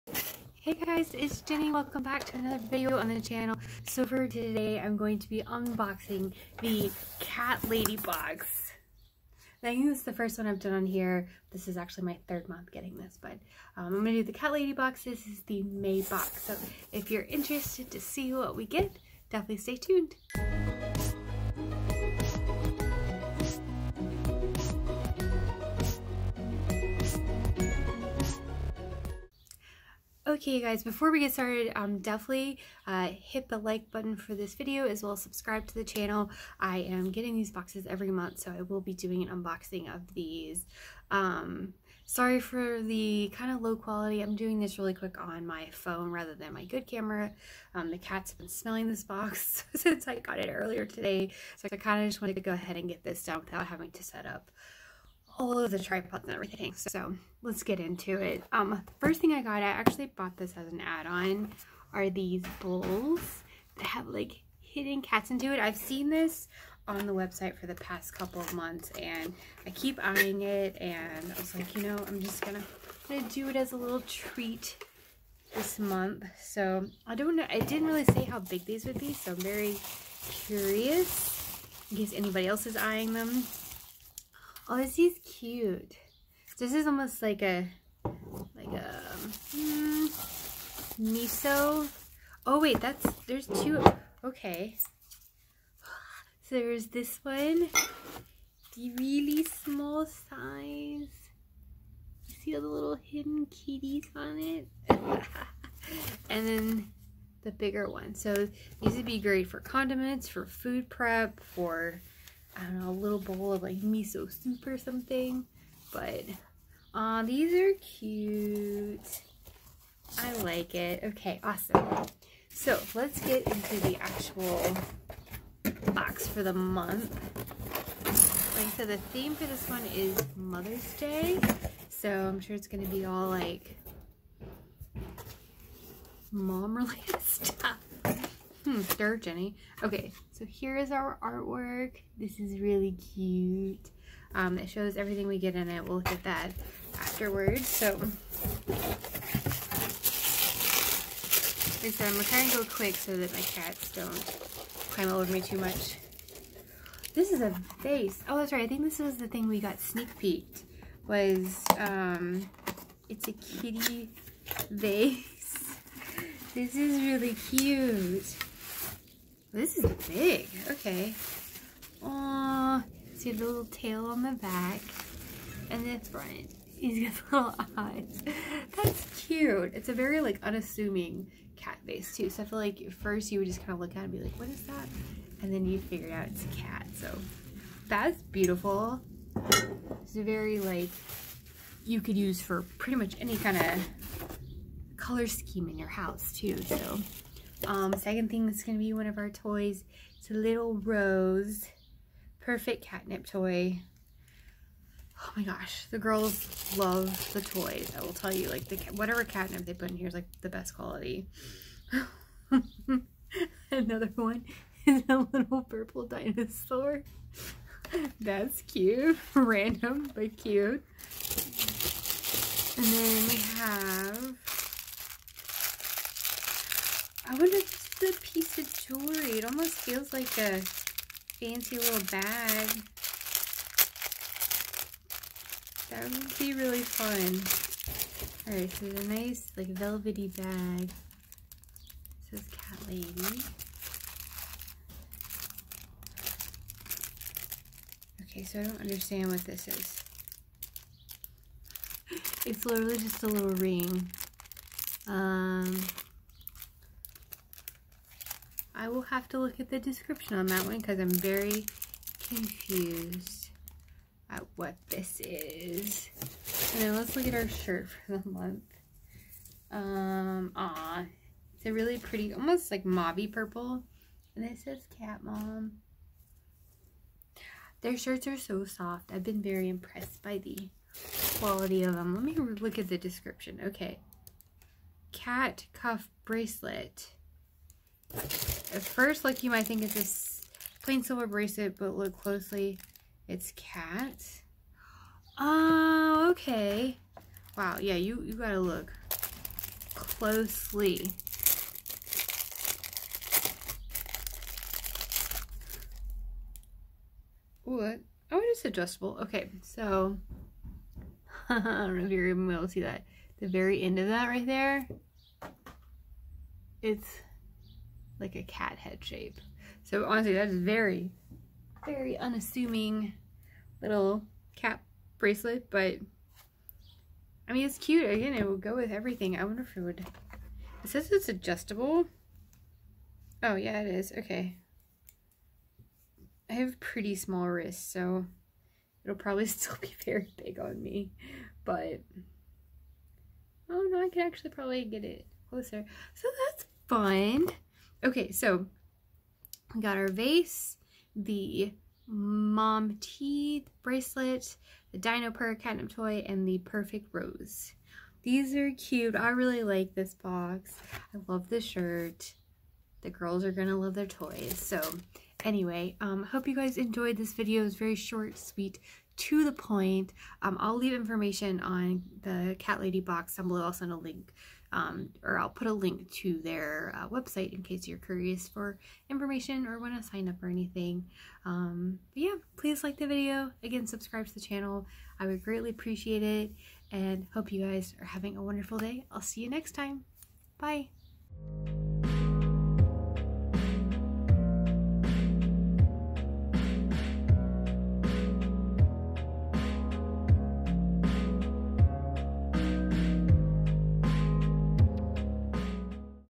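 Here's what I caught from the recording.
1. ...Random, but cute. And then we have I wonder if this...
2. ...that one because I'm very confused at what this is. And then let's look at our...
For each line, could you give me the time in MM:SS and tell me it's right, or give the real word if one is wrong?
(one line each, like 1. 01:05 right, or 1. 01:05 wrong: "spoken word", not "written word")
1. 03:39 right
2. 04:20 right.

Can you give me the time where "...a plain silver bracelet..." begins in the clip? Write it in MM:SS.
04:50.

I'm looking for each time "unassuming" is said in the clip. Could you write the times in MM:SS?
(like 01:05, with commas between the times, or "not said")
03:00, 05:22.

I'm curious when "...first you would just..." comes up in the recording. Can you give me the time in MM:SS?
03:02.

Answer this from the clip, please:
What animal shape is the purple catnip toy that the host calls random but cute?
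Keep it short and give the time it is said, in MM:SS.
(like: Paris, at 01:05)
Dinosaur, at 03:36.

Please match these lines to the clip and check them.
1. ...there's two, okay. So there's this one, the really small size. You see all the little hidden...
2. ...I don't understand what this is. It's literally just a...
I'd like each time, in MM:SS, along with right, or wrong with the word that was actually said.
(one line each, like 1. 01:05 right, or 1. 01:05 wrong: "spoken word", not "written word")
1. 01:33 right
2. 04:08 right.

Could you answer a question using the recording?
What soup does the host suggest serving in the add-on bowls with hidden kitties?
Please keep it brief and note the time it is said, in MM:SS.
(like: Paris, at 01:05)
Miso soup, at 01:53.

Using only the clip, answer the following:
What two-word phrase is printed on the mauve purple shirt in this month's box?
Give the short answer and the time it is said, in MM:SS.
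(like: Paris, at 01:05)
Cat Mom, at 04:34.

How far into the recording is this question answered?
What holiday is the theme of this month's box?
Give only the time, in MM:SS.
02:10.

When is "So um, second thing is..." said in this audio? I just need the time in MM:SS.
03:16.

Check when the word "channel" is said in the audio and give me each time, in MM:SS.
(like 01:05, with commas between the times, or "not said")
00:03, 00:35, 06:24.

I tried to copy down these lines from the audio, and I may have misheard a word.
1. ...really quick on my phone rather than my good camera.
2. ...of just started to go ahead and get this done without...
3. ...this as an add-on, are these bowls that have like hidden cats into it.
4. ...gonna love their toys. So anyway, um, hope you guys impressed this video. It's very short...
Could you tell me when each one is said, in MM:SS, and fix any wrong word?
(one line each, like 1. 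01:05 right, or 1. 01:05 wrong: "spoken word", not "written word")
1. 00:44 right
2. 00:52 wrong: "wanted", not "started"
3. 01:00 right
4. 06:03 wrong: "enjoyed", not "impressed".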